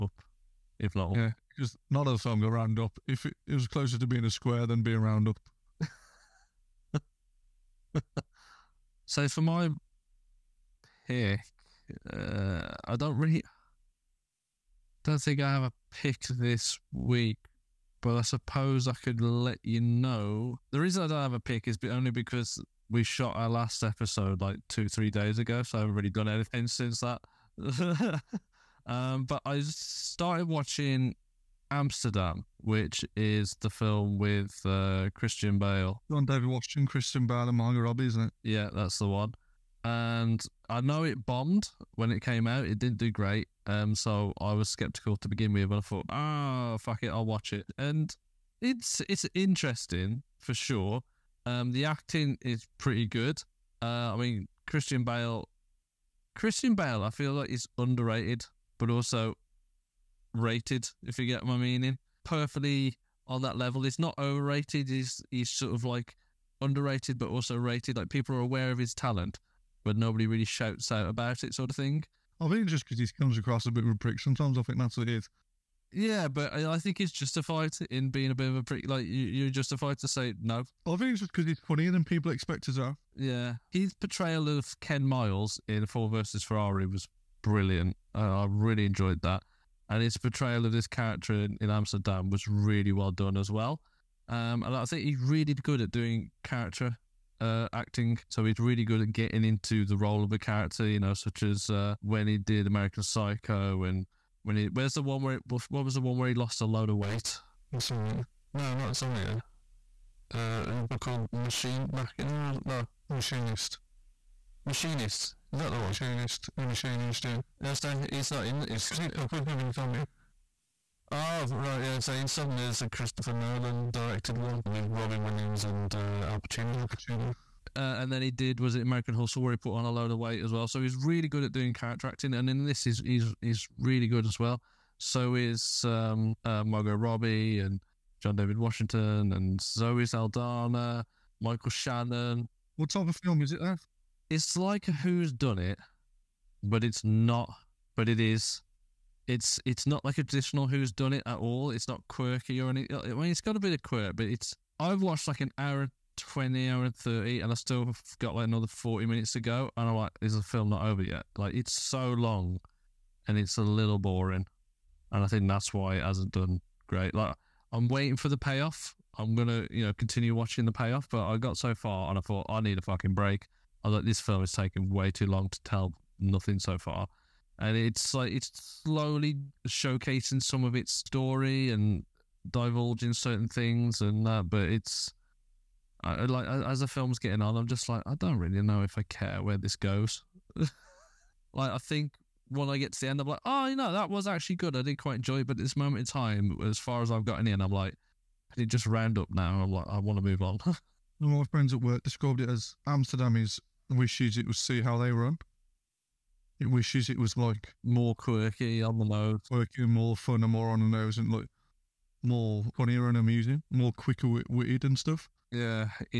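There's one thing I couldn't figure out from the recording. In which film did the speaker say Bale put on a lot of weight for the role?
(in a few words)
American Hustle.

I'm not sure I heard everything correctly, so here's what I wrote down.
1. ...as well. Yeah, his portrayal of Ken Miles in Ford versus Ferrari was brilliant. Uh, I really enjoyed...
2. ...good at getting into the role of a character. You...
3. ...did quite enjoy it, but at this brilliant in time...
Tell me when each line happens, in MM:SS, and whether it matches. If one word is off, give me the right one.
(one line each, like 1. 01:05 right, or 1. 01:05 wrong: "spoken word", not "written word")
1. 01:22 right
2. 01:38 right
3. 03:14 wrong: "moment", not "brilliant".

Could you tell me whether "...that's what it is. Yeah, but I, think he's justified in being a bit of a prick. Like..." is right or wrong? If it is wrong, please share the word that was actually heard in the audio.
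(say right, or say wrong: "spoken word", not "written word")
right.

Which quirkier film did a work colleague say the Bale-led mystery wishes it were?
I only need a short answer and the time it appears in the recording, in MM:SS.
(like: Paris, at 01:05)
See How They Run, at 03:24.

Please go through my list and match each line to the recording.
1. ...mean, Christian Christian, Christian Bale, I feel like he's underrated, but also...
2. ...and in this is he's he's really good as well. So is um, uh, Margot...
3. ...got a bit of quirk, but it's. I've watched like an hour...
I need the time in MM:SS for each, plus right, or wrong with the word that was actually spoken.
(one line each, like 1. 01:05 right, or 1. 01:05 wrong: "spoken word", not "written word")
1. 00:54 wrong: "Bale", not "Christian"
2. 02:12 right
3. 02:33 right.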